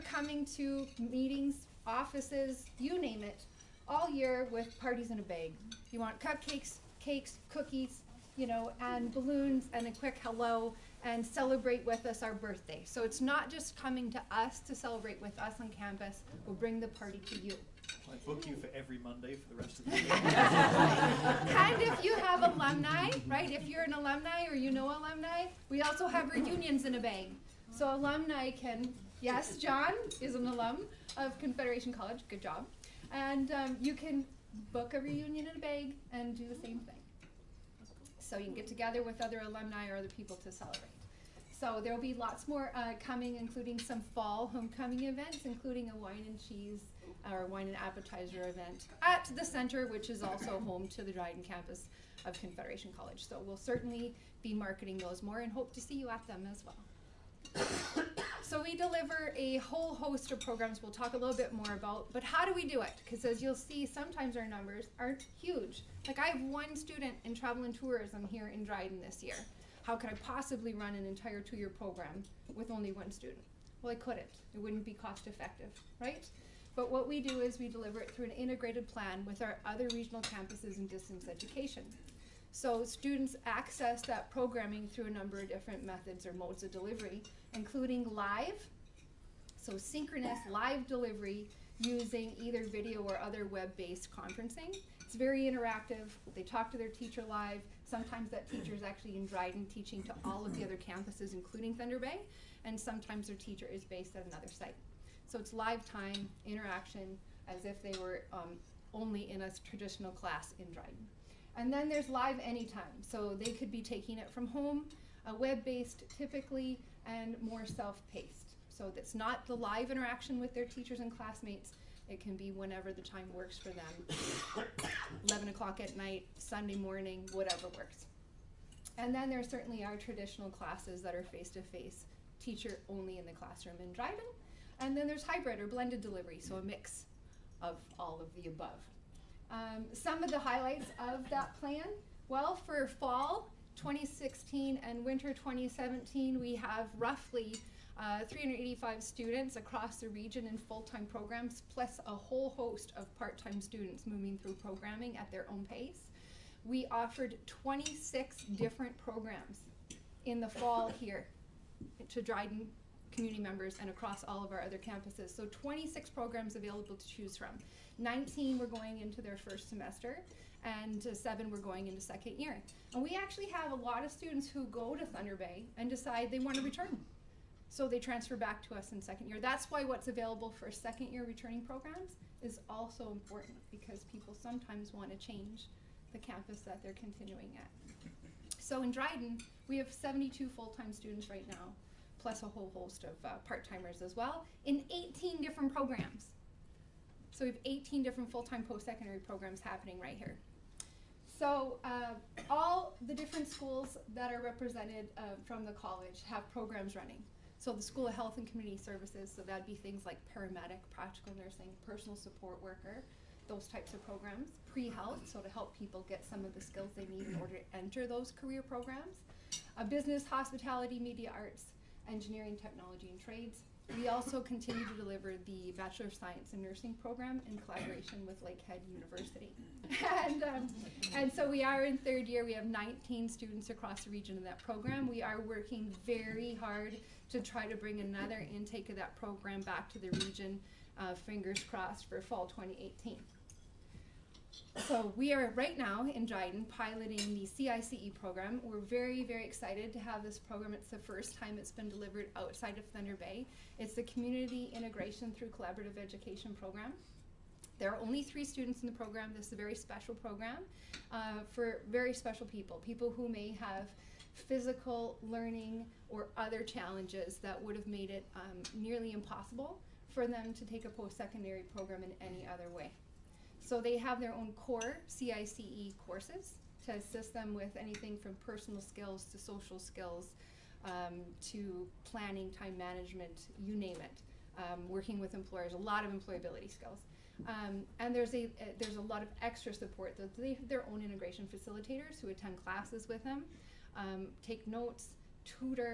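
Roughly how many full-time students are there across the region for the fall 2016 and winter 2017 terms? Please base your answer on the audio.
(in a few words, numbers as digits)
385.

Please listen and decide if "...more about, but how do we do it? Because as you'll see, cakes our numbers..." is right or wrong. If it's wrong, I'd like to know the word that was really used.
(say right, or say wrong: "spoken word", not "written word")
wrong: "sometimes", not "cakes".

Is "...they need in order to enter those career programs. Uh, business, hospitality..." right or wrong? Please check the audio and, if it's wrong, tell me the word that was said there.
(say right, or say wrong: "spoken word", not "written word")
right.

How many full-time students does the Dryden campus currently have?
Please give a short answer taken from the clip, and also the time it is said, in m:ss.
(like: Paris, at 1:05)
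72, at 3:09.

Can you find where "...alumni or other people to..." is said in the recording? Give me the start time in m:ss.
0:39.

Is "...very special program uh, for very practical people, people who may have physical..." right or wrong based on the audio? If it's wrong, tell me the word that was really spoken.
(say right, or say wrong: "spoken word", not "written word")
wrong: "special", not "practical".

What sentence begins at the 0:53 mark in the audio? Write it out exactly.
So we'll certainly be marketing those more and hope to see you at them as well.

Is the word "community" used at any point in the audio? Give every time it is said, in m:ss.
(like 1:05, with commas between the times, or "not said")
2:43, 3:28, 4:14.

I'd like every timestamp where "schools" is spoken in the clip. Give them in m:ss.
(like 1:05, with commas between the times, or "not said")
3:23, 3:27.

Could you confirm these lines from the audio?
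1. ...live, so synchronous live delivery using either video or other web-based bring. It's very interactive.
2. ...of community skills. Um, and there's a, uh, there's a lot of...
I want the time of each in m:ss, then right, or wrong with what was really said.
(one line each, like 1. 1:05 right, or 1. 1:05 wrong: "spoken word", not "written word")
1. 1:28 wrong: "conferencing", not "bring"
2. 4:46 wrong: "employability", not "community".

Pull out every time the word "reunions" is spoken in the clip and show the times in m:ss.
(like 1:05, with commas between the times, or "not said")
0:26, 0:34.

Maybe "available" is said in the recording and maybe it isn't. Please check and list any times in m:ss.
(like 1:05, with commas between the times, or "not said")
2:46, 3:00.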